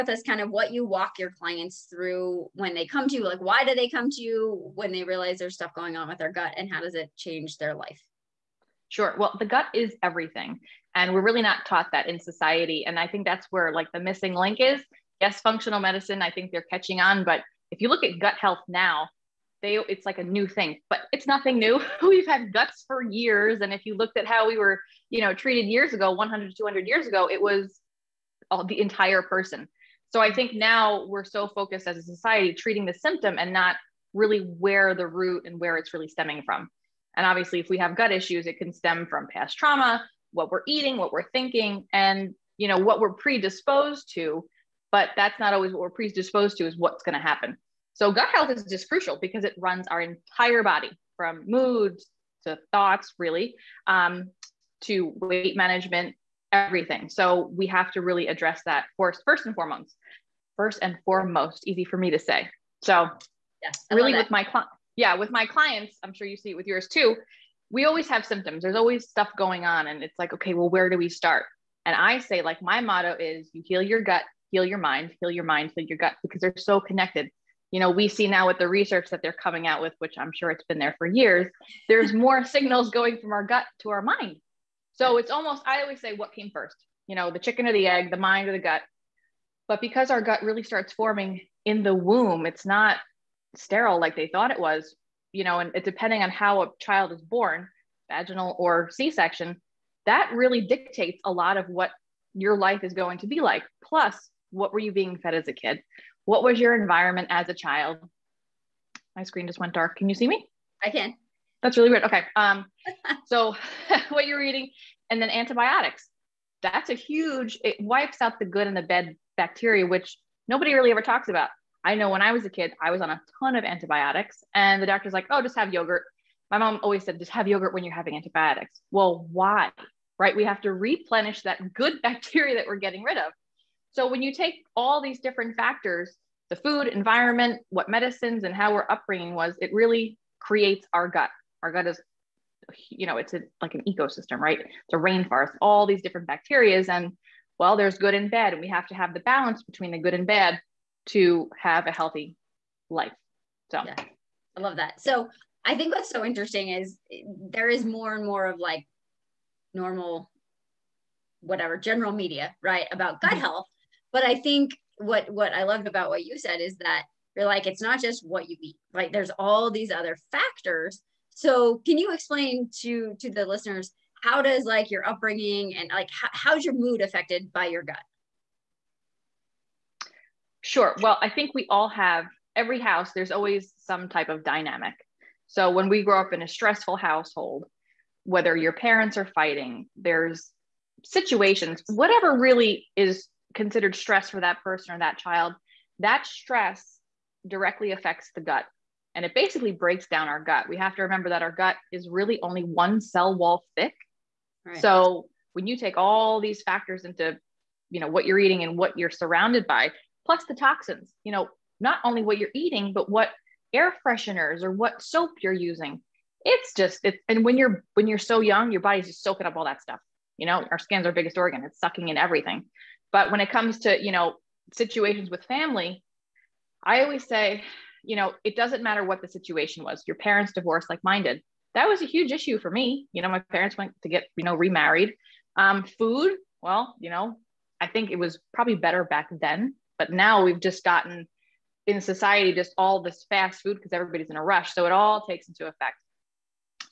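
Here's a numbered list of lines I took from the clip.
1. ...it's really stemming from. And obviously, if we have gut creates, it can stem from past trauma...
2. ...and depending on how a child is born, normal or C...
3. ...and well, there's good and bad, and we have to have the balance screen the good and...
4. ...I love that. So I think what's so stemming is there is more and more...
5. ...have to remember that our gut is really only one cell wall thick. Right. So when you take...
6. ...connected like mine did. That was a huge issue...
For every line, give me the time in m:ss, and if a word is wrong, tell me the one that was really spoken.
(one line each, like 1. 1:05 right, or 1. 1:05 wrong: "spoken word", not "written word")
1. 0:35 wrong: "issues", not "creates"
2. 1:35 wrong: "vaginal", not "normal"
3. 2:26 wrong: "between", not "screen"
4. 2:34 wrong: "interesting", not "stemming"
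5. 3:20 right
6. 3:50 wrong: "divorced", not "connected".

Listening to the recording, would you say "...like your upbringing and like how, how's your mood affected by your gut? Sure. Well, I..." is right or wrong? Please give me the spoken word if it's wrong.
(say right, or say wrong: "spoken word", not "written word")
right.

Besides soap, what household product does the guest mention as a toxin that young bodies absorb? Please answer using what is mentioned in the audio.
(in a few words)
Air fresheners.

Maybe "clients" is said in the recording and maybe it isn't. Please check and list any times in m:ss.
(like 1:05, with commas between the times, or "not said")
0:01, 1:05.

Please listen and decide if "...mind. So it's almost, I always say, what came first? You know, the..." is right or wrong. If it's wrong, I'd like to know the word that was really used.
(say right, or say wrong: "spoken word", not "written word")
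right.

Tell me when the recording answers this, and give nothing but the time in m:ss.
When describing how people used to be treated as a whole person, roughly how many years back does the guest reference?
0:26.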